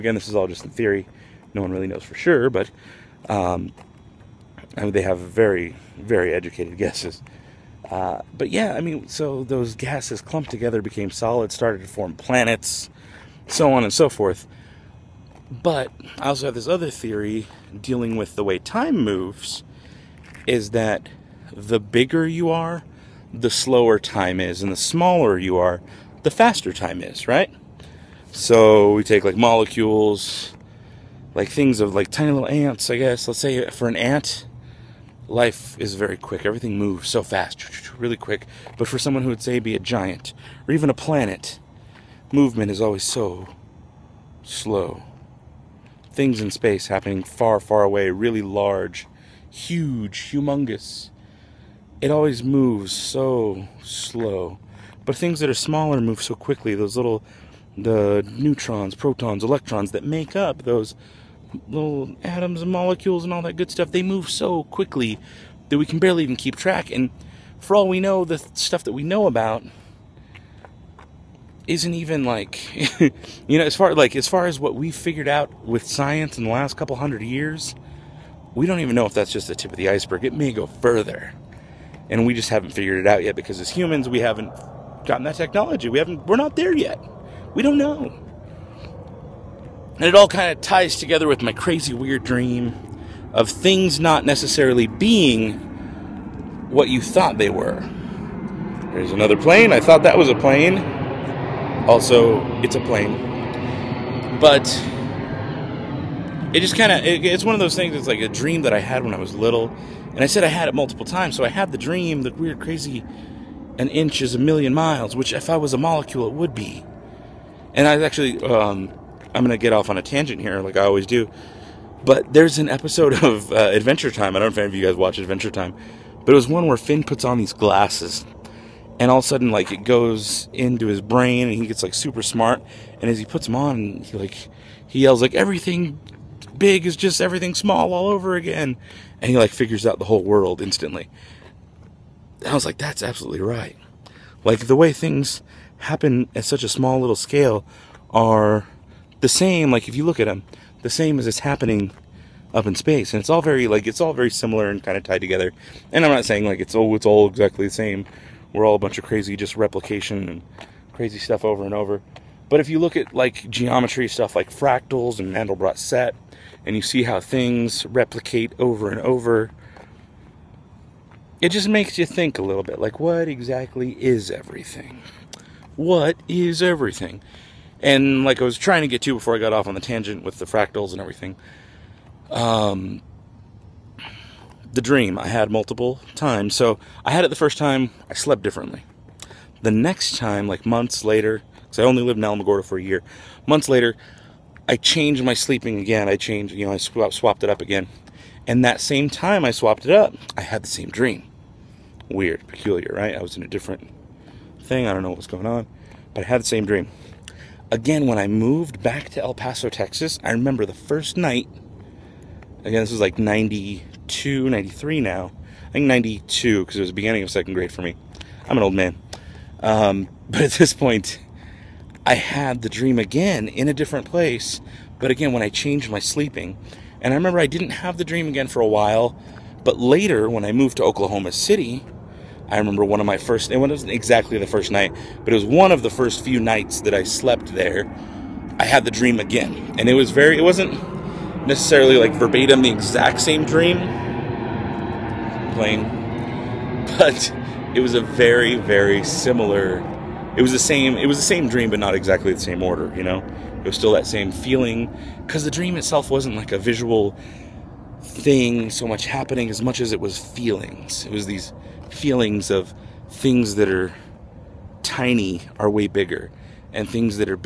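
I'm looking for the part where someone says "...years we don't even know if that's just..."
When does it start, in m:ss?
1:17.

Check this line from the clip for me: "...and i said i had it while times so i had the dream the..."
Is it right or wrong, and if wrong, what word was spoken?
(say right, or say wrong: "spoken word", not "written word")
wrong: "multiple", not "while".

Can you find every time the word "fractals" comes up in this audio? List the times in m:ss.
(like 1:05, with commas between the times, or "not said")
2:44, 3:00.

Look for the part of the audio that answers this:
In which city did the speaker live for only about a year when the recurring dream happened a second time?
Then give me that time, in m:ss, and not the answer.
3:12.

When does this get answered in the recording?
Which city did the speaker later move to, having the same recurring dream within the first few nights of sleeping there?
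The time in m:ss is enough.
3:50.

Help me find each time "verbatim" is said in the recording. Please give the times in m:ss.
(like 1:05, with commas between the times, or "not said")
4:02.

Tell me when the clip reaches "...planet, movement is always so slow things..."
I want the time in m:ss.
0:40.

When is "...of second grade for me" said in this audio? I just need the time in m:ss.
3:37.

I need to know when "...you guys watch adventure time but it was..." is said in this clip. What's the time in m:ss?
2:04.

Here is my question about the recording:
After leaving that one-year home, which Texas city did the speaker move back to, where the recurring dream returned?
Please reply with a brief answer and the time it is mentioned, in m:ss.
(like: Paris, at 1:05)
El Paso, at 3:29.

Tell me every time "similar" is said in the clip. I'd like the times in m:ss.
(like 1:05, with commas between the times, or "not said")
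2:34, 4:09.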